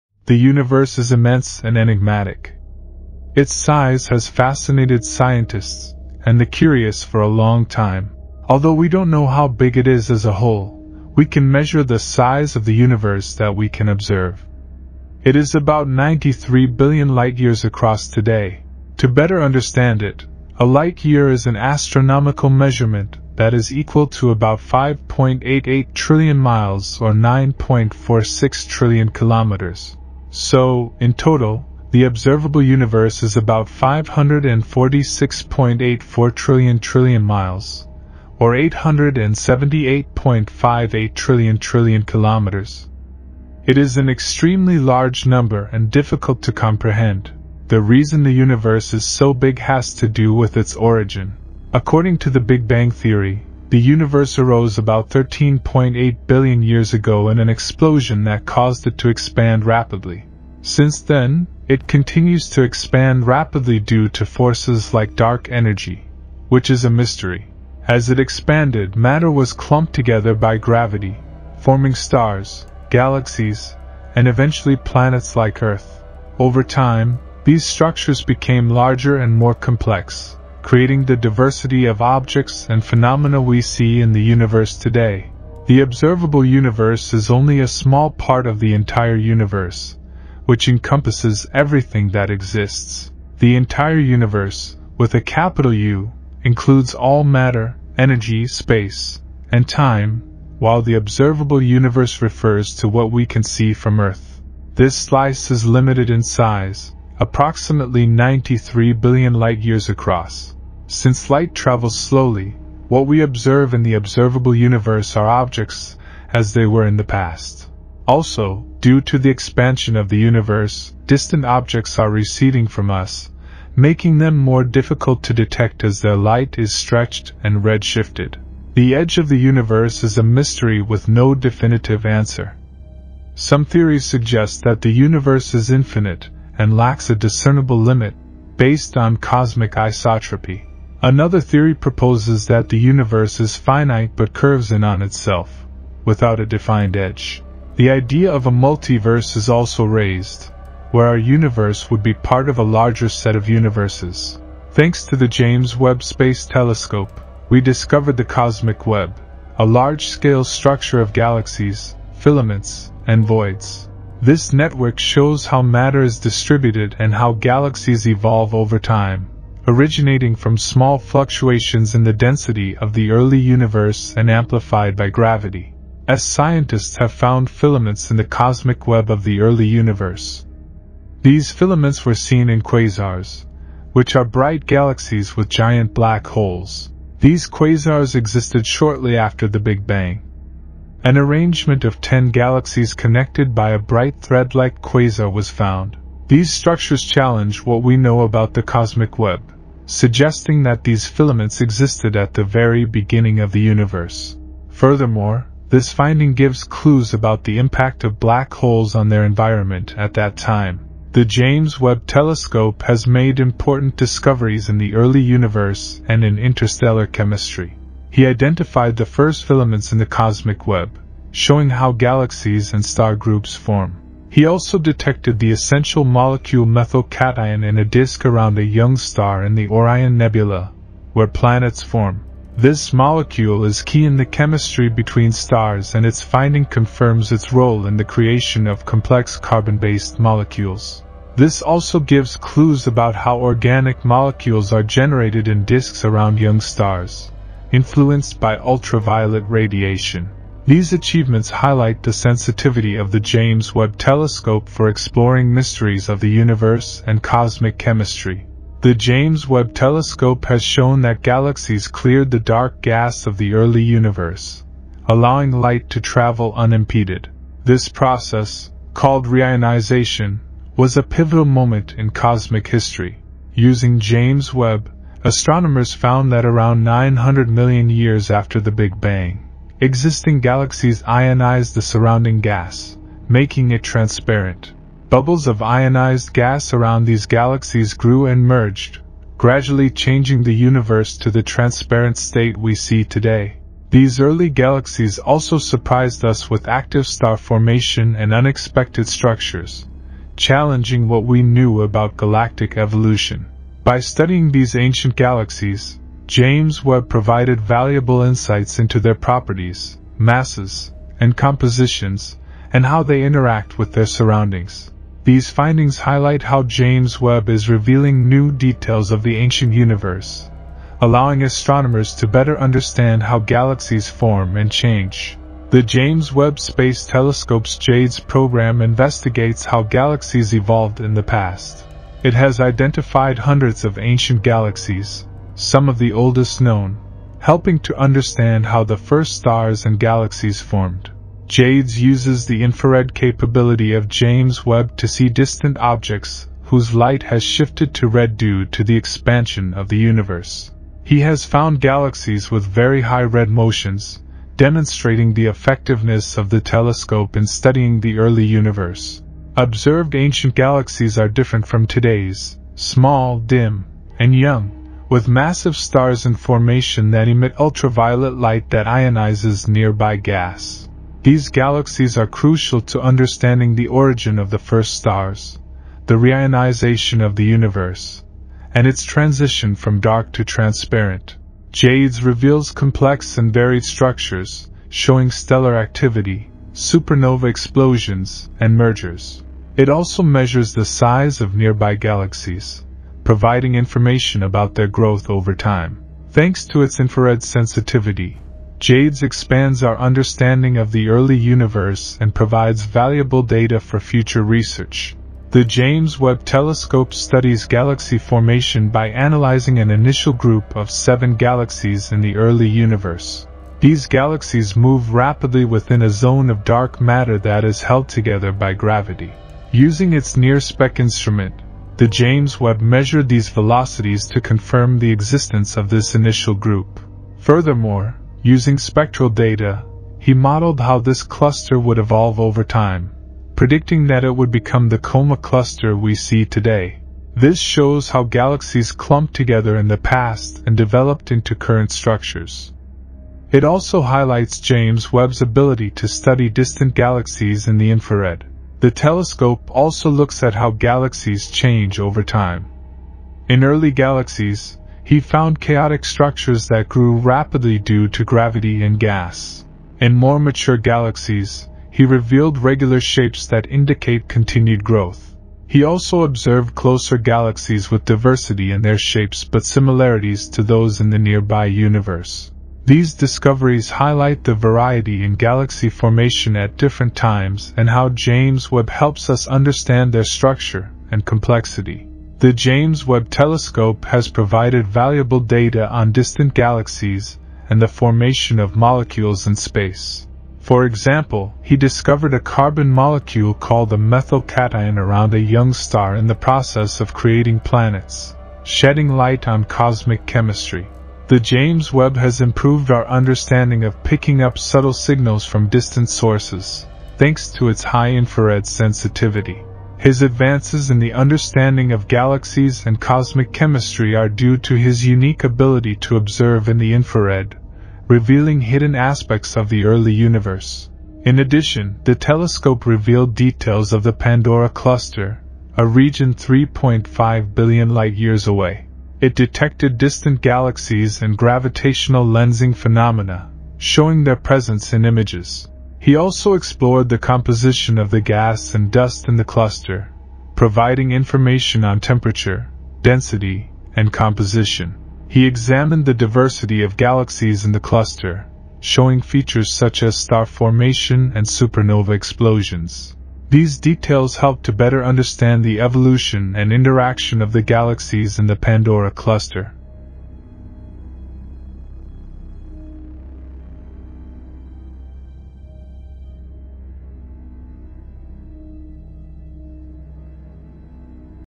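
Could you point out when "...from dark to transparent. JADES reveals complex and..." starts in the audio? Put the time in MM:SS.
06:19.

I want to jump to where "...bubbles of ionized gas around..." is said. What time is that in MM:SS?
04:45.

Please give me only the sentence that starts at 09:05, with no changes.
He examined the diversity of galaxies in the cluster, showing features such as star formation and supernova explosions.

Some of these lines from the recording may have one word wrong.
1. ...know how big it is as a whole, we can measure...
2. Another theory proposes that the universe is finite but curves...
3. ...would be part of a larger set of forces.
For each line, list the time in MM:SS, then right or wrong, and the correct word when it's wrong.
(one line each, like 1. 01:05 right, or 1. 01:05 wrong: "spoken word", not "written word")
1. 00:09 right
2. 02:21 right
3. 02:31 wrong: "universes", not "forces".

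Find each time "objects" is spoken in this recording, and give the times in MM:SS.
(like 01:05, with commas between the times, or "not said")
01:22, 01:55, 02:01, 05:45.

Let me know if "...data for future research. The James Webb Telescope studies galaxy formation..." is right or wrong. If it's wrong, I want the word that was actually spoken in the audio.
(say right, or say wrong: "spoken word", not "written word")
right.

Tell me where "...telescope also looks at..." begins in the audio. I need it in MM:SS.
07:28.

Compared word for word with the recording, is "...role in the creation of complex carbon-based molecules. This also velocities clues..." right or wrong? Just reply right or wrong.
wrong.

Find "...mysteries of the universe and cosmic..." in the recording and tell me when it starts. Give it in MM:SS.
04:15.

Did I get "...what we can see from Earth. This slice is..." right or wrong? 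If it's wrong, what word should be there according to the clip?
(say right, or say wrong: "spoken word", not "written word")
right.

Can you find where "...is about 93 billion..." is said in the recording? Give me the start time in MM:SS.
00:15.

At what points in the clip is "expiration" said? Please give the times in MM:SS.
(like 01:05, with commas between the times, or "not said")
not said.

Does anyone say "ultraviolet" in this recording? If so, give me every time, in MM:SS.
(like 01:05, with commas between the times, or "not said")
04:08, 06:07.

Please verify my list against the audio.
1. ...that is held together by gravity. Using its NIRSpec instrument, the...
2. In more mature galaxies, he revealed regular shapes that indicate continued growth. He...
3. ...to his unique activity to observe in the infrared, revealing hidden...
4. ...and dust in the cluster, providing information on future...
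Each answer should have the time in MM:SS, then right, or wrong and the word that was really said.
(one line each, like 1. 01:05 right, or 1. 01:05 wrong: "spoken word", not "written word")
1. 06:57 right
2. 07:39 right
3. 08:34 wrong: "ability", not "activity"
4. 08:58 wrong: "temperature", not "future".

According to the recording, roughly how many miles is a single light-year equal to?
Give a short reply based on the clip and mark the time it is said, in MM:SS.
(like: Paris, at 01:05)
5.88 trillion miles, at 00:24.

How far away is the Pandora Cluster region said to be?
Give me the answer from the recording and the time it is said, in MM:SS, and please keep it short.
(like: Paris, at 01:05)
3.5 billion light-years, at 08:46.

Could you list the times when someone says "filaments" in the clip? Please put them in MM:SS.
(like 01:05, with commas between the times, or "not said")
02:42, 02:57, 03:01, 03:21, 03:39.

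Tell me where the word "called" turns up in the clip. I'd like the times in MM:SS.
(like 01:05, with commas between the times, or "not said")
04:28, 08:13.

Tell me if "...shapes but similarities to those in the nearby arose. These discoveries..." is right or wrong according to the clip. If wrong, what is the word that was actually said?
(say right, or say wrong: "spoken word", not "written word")
wrong: "universe", not "arose".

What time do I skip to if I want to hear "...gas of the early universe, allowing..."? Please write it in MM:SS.
04:22.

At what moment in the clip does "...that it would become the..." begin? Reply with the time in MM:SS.
07:14.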